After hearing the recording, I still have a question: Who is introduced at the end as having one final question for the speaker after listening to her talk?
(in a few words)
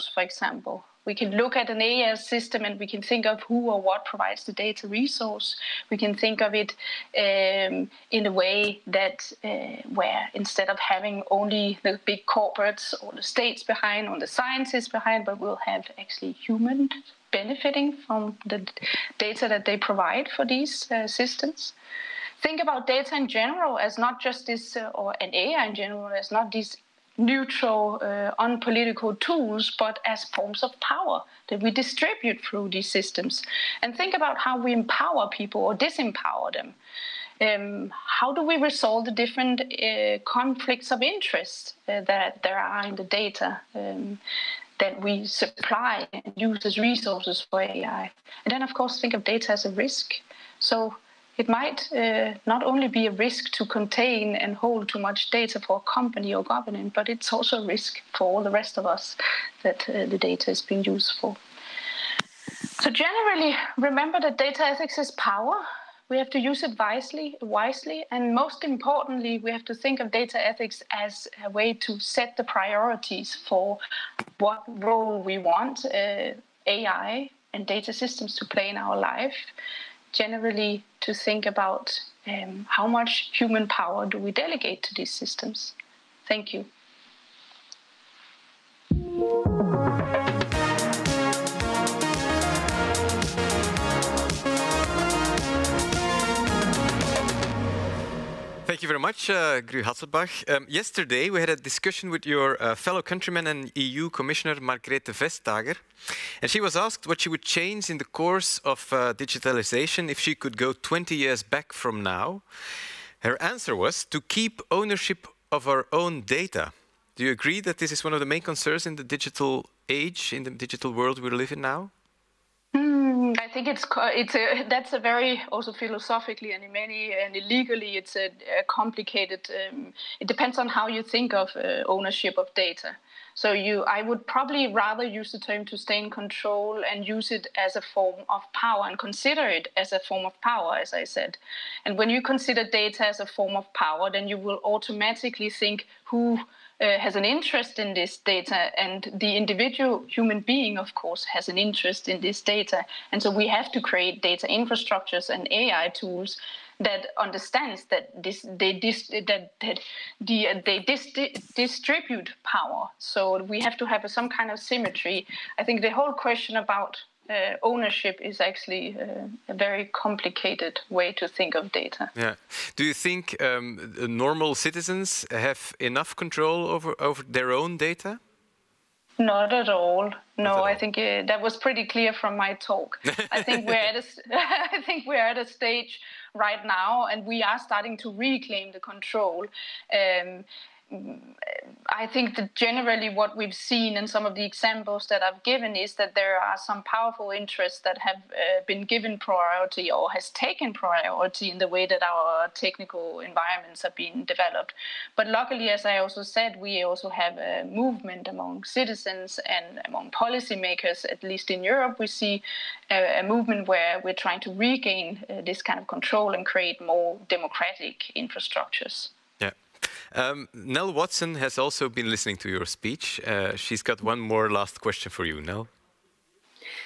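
Nell Watson.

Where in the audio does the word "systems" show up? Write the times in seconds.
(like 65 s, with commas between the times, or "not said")
2 s, 21 s, 32 s, 78 s, 85 s.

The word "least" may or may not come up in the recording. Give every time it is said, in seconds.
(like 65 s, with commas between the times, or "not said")
211 s.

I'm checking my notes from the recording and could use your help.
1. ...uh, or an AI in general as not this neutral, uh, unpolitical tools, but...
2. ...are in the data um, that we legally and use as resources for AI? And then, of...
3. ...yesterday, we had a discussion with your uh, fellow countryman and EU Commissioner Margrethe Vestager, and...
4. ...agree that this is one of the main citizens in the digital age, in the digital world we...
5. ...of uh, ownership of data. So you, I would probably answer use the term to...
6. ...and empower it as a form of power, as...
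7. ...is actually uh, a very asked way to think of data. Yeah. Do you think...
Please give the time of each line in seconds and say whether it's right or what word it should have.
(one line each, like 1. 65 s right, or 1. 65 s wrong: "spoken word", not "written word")
1. 24 s right
2. 42 s wrong: "supply", not "legally"
3. 100 s right
4. 117 s wrong: "concerns", not "citizens"
5. 131 s wrong: "rather", not "answer"
6. 138 s wrong: "consider", not "empower"
7. 168 s wrong: "complicated", not "asked".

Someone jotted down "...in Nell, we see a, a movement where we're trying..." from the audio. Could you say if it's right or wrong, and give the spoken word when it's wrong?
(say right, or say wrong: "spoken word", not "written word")
wrong: "Europe", not "Nell".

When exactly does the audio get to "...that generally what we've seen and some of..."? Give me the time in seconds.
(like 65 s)
192 s.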